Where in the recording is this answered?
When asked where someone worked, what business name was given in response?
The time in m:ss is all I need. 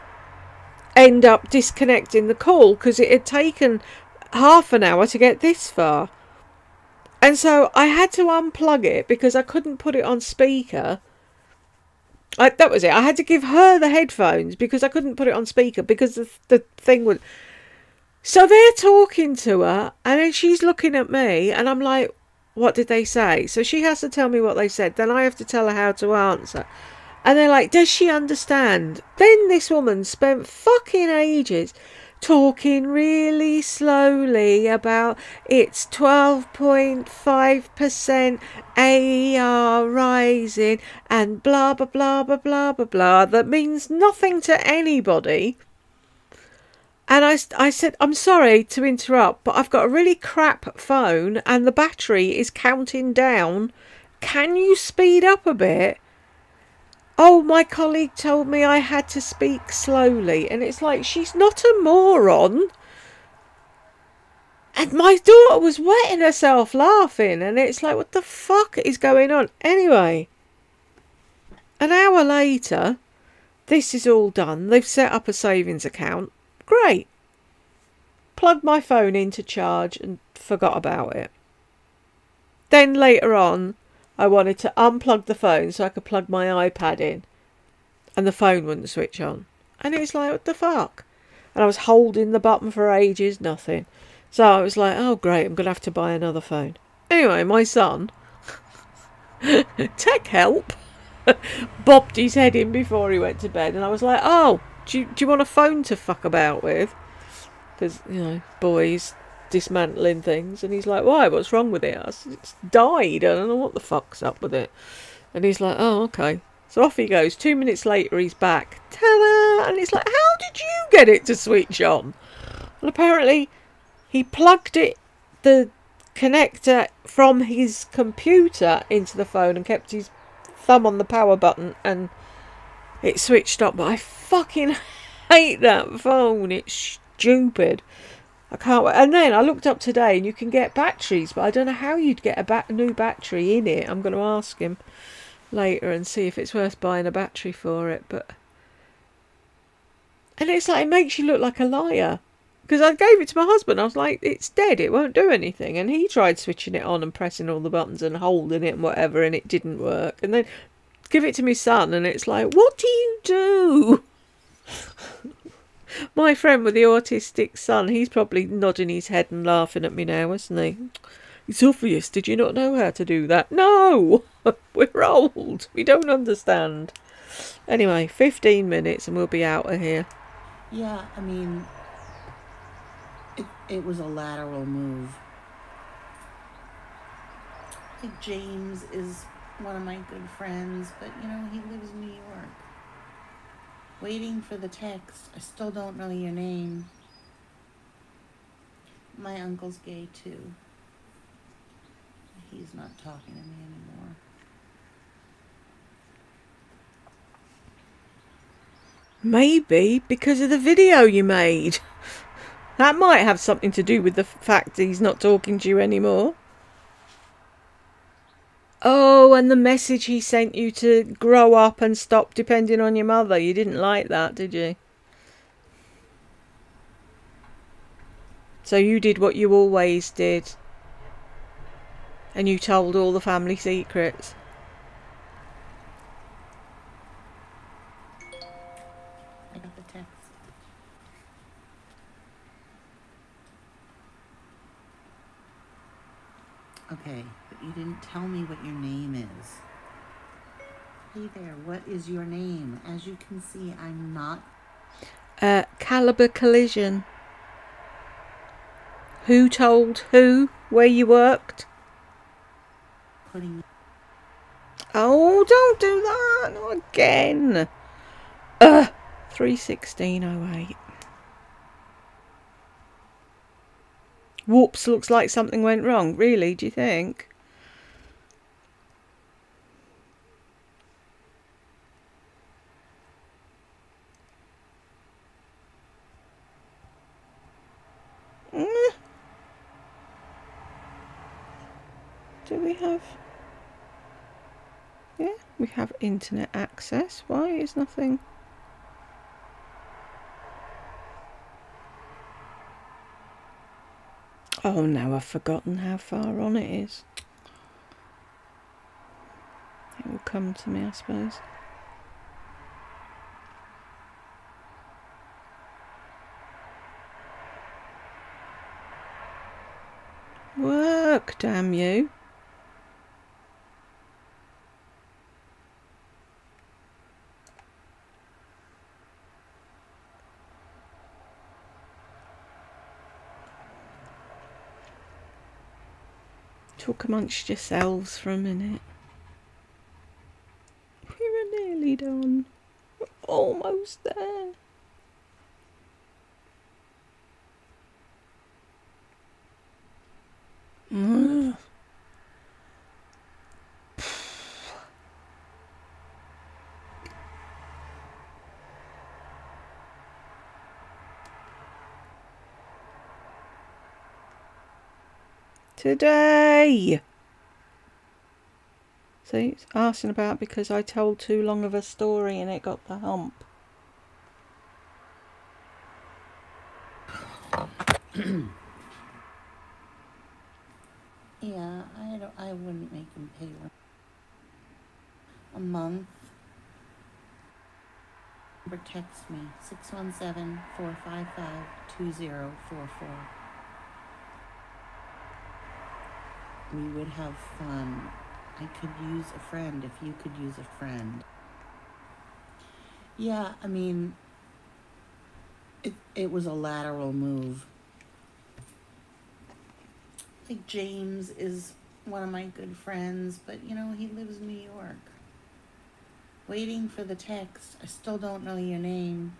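4:15.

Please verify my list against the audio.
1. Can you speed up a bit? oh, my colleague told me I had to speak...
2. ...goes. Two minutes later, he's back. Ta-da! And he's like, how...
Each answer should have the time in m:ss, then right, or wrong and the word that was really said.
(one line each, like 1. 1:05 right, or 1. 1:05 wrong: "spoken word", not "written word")
1. 0:54 right
2. 1:57 right.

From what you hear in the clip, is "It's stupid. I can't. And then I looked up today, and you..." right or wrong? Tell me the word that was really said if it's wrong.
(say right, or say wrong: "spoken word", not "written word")
right.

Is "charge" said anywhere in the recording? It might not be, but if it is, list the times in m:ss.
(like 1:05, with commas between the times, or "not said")
1:19.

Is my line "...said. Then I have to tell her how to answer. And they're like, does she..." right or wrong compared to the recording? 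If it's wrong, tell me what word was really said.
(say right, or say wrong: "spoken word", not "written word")
right.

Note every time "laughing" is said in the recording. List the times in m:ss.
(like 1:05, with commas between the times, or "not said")
1:06, 2:49.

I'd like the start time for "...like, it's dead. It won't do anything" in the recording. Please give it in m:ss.
2:33.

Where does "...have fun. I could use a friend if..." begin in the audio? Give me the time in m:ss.
6:37.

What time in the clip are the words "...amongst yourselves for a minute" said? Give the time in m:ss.
5:37.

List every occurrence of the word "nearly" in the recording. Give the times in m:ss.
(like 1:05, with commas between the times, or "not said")
5:41.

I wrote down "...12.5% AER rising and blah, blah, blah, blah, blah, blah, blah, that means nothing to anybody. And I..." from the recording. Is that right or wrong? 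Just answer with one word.
right.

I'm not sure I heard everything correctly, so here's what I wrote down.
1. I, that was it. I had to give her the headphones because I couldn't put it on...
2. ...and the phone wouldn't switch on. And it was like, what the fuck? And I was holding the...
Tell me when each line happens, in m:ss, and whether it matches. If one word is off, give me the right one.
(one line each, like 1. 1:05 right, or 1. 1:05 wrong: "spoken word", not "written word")
1. 0:12 right
2. 1:28 right.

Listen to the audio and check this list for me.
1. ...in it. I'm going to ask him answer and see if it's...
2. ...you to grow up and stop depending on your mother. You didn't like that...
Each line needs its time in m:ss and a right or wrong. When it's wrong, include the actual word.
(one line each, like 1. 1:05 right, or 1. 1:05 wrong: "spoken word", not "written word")
1. 2:23 wrong: "later", not "answer"
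2. 3:40 right.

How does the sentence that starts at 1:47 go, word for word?
Because, you know, boys, dismantling things.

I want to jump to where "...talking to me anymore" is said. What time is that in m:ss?
3:23.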